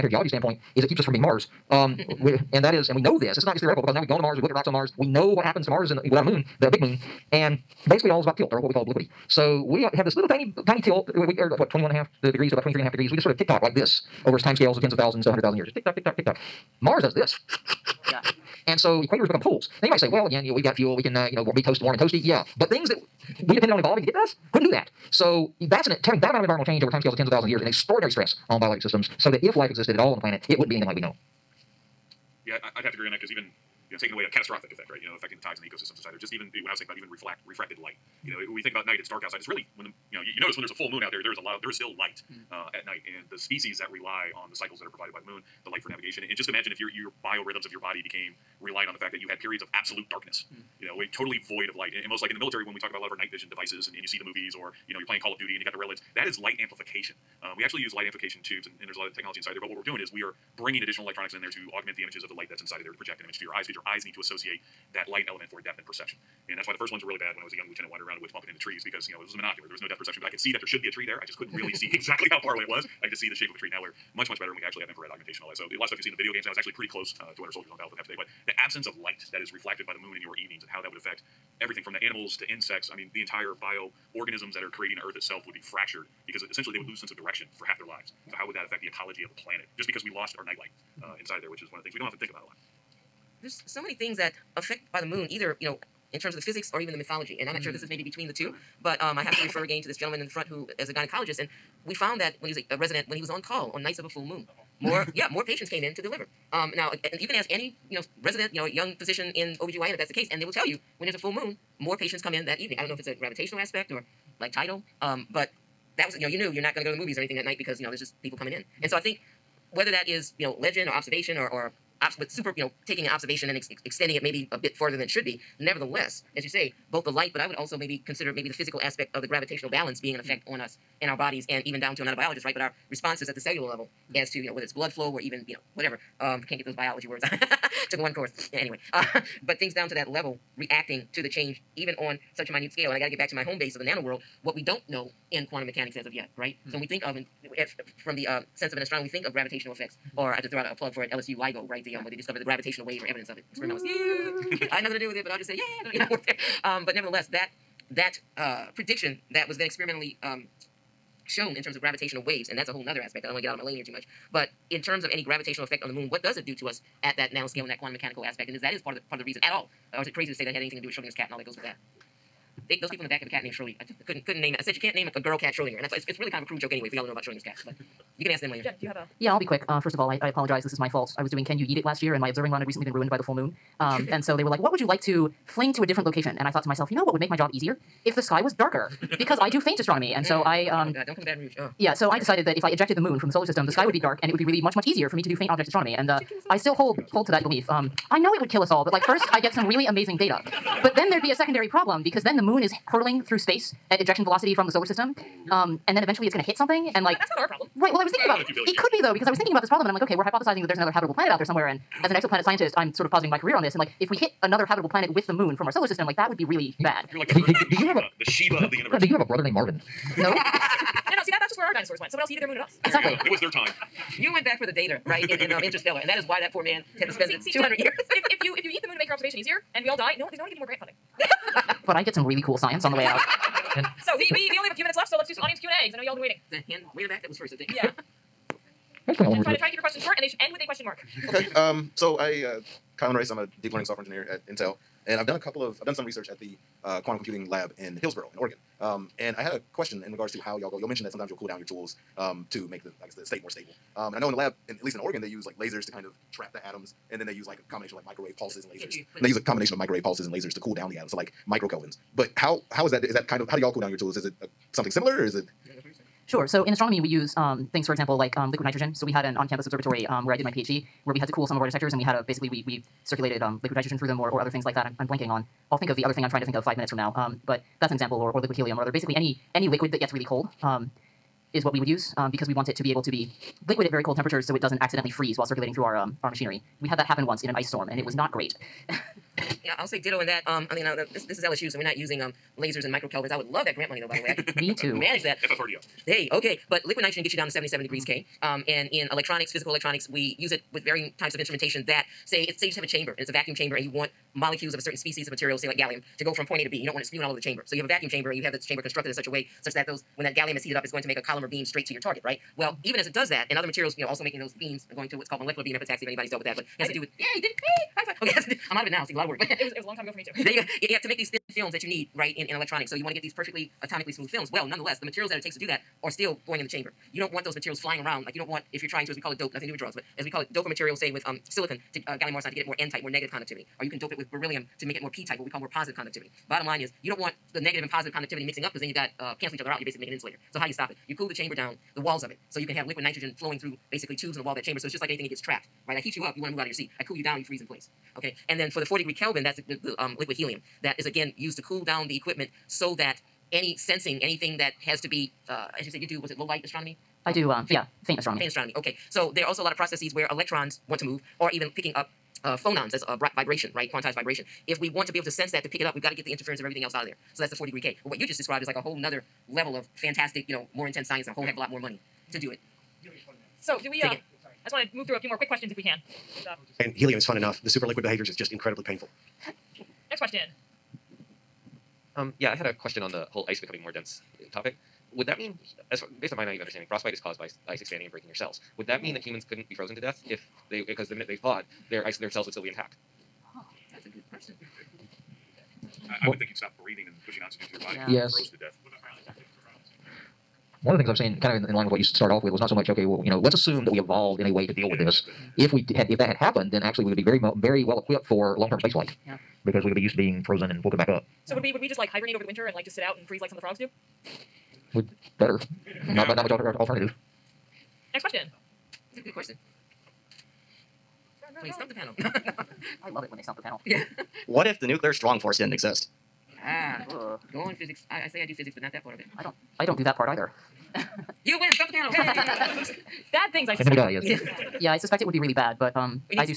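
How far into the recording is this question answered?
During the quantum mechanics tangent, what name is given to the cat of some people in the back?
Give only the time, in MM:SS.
02:53.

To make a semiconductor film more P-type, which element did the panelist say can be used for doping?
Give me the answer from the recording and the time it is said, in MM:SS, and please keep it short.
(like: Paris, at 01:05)
beryllium, at 05:34.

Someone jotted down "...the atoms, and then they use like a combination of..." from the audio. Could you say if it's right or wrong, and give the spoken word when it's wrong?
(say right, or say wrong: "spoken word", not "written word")
right.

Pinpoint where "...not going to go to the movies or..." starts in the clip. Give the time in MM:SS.
01:56.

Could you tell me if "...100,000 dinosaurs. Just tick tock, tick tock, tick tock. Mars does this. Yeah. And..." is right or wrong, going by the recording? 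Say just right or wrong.
wrong.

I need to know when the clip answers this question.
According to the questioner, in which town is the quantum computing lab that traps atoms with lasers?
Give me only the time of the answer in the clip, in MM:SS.
04:08.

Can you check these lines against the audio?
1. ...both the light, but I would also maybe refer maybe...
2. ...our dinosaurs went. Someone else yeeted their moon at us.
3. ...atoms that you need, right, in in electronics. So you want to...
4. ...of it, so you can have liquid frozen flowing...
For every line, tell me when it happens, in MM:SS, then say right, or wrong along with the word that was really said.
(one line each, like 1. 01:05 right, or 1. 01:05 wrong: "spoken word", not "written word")
1. 02:06 wrong: "consider", not "refer"
2. 03:41 right
3. 05:21 wrong: "films", not "atoms"
4. 05:42 wrong: "nitrogen", not "frozen".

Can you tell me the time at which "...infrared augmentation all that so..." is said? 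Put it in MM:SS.
01:14.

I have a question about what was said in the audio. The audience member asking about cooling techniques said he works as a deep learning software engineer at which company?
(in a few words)
Intel.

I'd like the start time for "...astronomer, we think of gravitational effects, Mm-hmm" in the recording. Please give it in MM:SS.
02:28.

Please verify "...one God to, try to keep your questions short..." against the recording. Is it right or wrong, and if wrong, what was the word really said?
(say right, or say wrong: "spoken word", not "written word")
wrong: "Try", not "God".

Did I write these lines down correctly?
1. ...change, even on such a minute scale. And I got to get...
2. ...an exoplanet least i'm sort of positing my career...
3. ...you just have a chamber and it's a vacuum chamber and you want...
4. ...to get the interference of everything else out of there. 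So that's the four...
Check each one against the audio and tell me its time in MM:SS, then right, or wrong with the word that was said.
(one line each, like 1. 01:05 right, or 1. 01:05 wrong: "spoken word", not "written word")
1. 02:21 right
2. 03:32 wrong: "scientist", not "least"
3. 05:02 right
4. 06:06 right.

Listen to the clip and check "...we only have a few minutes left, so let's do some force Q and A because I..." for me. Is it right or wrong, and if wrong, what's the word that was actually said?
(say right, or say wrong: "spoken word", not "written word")
wrong: "audience", not "force".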